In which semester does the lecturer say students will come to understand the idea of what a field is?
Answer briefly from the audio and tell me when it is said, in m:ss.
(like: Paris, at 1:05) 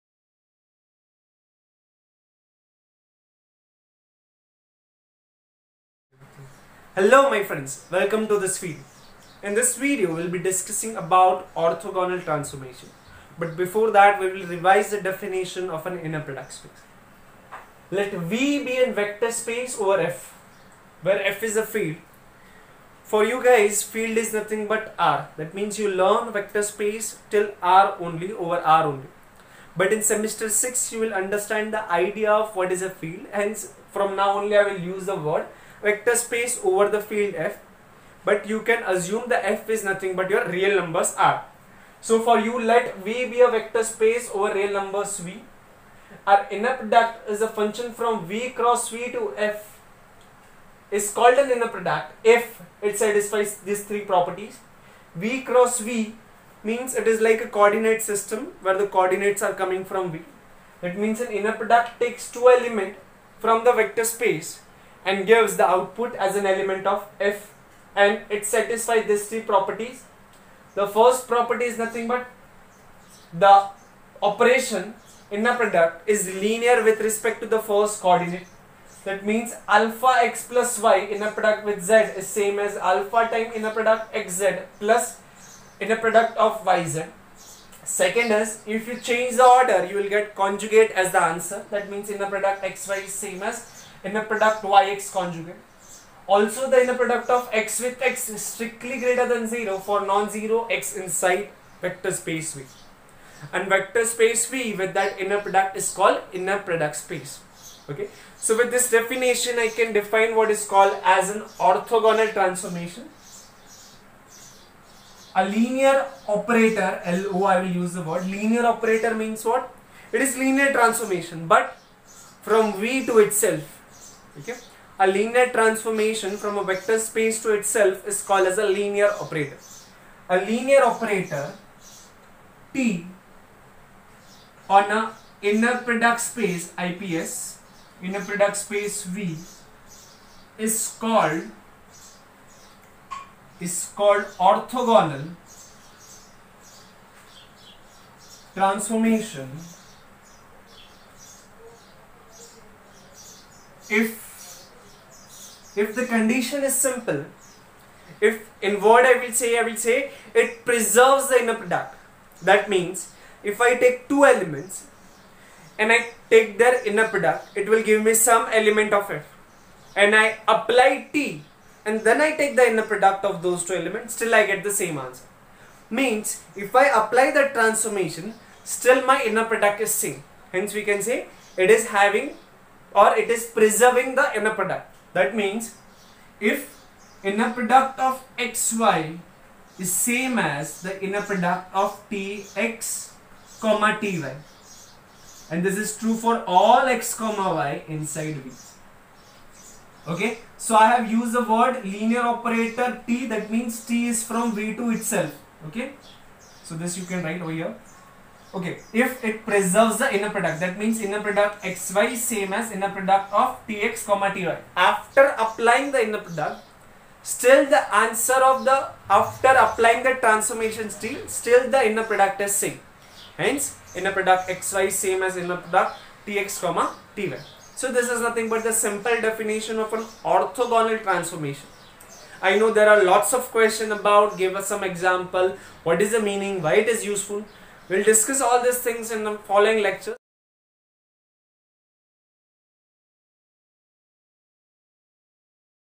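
Semester 6, at 0:30.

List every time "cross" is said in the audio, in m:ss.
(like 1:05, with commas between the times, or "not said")
0:48, 0:55.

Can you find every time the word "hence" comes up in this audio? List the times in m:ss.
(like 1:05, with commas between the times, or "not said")
0:33, 3:00, 3:43.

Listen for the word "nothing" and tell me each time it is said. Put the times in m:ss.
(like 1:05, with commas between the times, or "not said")
0:24, 0:39, 1:11, 3:48.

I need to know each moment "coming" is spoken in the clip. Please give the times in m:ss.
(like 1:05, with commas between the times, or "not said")
0:59.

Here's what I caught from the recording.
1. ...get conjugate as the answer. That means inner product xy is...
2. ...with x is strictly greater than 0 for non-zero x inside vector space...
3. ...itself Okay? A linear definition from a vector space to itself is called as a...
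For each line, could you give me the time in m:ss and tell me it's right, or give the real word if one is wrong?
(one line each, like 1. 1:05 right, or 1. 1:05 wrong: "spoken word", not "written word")
1. 1:30 right
2. 1:37 right
3. 2:03 wrong: "transformation", not "definition".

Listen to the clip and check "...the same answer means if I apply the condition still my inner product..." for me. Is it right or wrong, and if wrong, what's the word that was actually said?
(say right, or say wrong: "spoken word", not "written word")
wrong: "transformation", not "condition".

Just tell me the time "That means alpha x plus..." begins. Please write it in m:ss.
1:19.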